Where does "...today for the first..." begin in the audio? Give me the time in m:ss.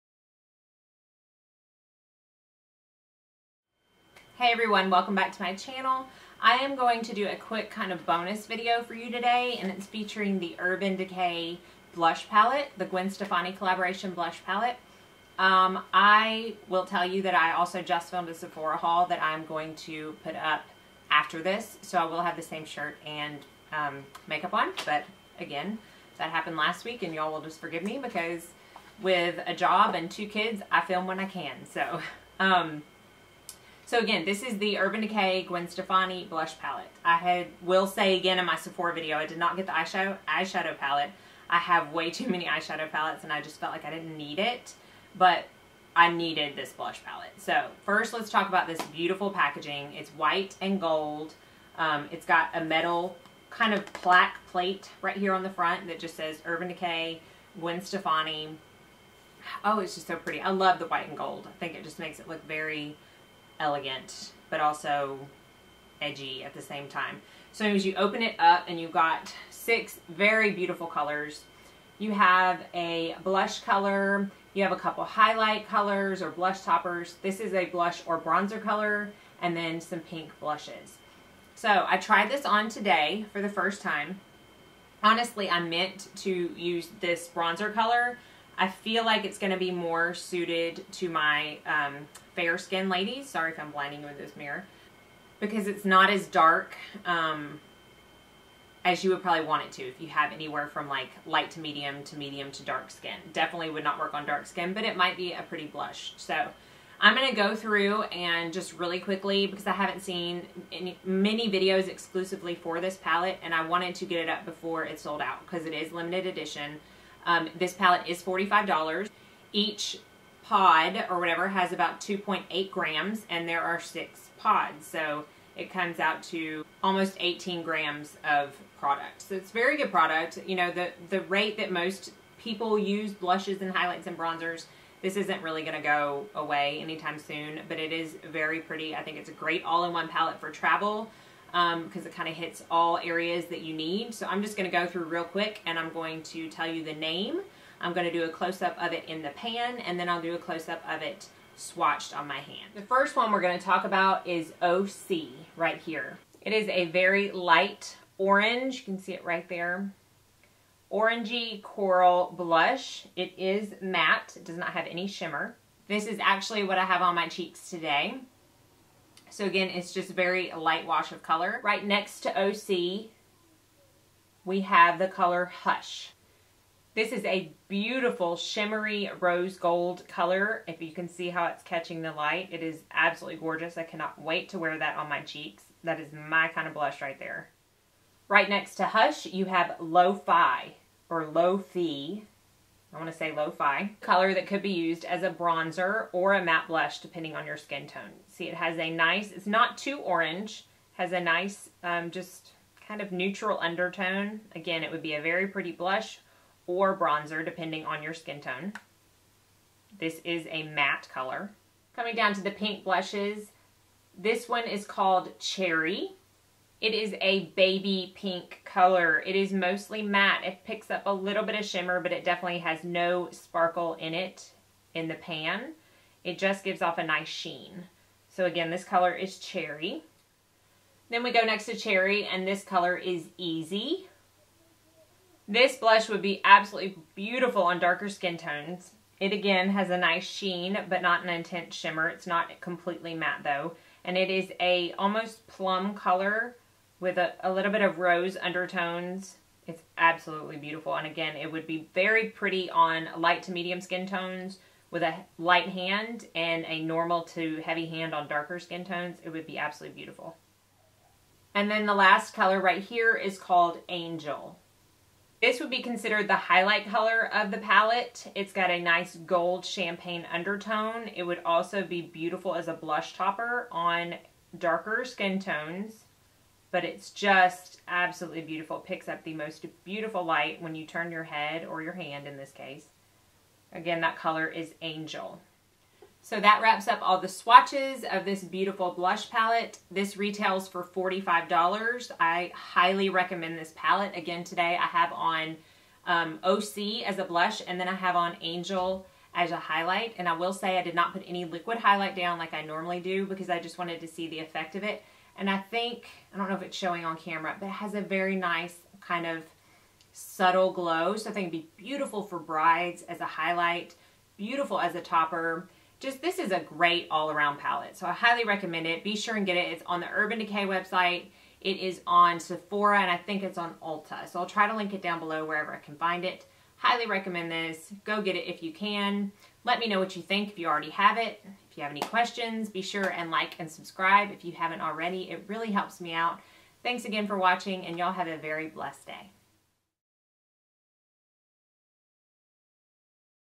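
1:22.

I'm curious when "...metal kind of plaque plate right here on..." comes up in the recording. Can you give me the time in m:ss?
0:52.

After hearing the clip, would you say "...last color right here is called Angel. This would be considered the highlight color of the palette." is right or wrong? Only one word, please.
right.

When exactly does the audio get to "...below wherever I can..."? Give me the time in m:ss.
5:25.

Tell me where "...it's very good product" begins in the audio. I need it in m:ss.
2:09.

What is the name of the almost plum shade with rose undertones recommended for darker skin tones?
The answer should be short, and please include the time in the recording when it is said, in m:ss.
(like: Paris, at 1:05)
Easy, at 3:53.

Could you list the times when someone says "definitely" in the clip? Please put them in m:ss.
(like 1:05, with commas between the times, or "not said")
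1:43, 3:42.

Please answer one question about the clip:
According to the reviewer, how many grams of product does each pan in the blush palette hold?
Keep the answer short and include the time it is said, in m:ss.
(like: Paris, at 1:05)
2.8 grams, at 2:02.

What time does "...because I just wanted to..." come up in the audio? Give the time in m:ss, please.
5:03.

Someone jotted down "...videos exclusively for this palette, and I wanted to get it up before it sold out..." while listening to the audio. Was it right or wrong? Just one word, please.
right.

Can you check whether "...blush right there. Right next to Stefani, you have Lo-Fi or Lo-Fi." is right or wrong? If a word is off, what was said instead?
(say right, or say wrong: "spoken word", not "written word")
wrong: "Hush", not "Stefani".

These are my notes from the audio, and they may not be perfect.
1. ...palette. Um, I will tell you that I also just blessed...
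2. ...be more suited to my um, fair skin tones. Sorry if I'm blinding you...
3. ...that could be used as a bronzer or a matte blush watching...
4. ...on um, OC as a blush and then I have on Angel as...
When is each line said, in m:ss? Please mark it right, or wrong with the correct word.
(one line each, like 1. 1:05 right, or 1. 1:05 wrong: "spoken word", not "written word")
1. 0:14 wrong: "filmed", not "blessed"
2. 1:29 wrong: "ladies", not "tones"
3. 3:14 wrong: "depending", not "watching"
4. 4:55 right.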